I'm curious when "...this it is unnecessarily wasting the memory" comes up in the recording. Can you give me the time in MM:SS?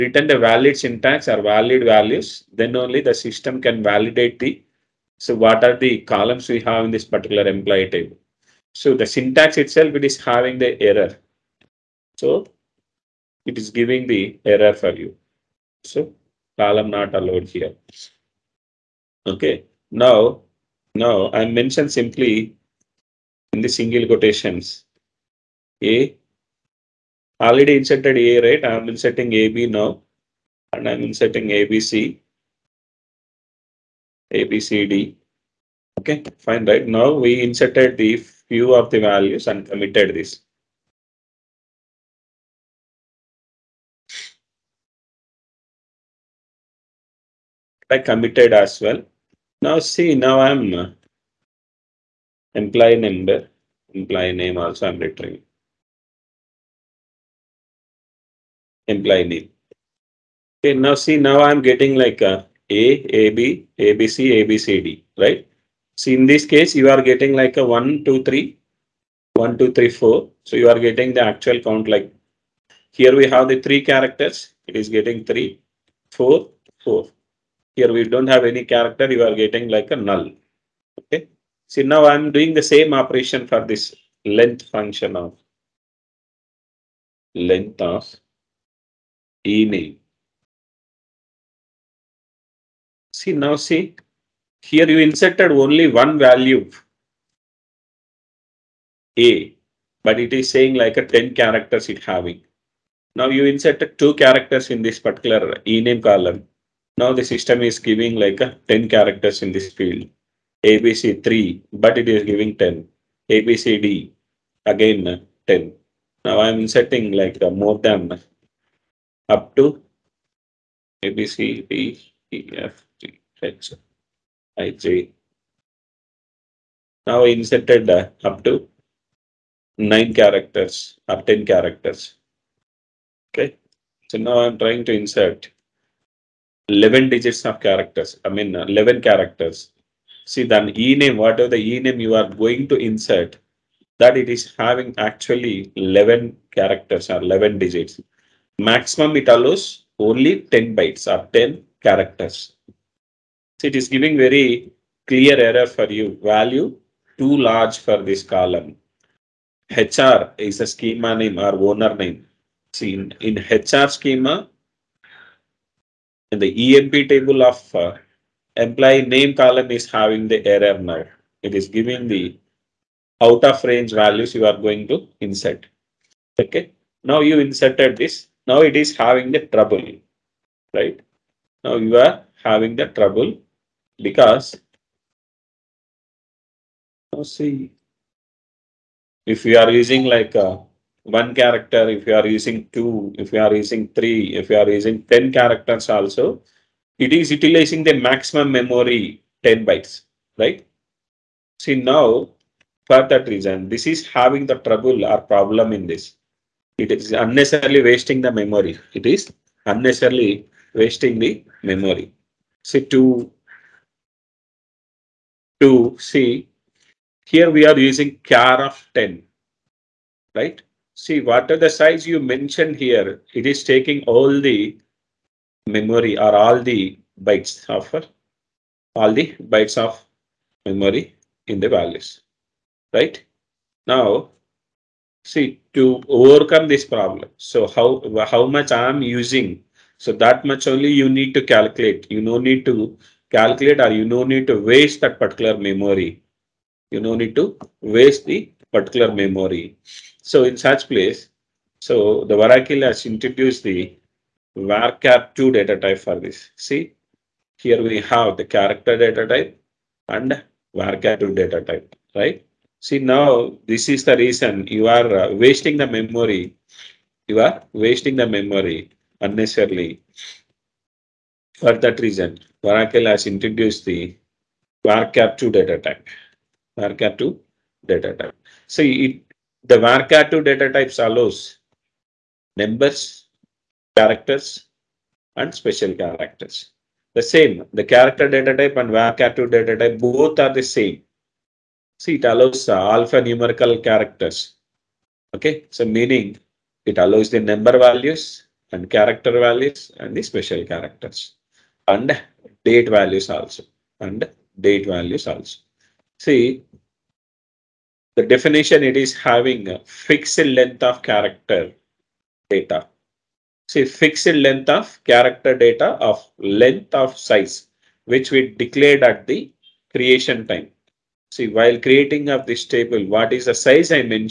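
03:25.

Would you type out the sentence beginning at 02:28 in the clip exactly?
Maximum it allows only 10 bytes or 10 characters.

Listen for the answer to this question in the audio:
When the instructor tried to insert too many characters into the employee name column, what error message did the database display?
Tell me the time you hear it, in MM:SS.
02:36.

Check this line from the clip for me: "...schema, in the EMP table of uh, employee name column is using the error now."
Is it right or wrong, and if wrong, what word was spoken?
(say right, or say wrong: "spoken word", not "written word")
wrong: "having", not "using".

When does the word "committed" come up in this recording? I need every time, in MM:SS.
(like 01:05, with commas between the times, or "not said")
00:39, 00:47.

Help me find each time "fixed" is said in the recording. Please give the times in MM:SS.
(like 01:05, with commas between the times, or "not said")
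05:09, 05:13.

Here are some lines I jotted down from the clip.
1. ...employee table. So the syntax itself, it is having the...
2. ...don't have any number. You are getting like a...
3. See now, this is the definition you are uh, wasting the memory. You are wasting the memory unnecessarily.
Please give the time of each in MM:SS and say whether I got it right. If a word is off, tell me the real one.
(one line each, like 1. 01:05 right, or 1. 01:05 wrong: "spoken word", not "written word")
1. 00:07 right
2. 01:18 wrong: "character", not "number"
3. 04:22 wrong: "reason", not "definition".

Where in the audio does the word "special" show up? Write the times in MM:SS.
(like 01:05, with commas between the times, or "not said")
04:45, 05:00.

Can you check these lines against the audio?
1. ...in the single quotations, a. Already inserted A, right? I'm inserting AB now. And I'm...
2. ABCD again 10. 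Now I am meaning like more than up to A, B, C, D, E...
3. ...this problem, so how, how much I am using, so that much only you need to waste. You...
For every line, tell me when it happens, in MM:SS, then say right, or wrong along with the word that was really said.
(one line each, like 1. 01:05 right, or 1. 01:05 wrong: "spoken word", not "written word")
1. 00:23 right
2. 01:53 wrong: "inserting", not "meaning"
3. 03:56 wrong: "calculate", not "waste".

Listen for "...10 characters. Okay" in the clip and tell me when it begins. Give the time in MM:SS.
02:11.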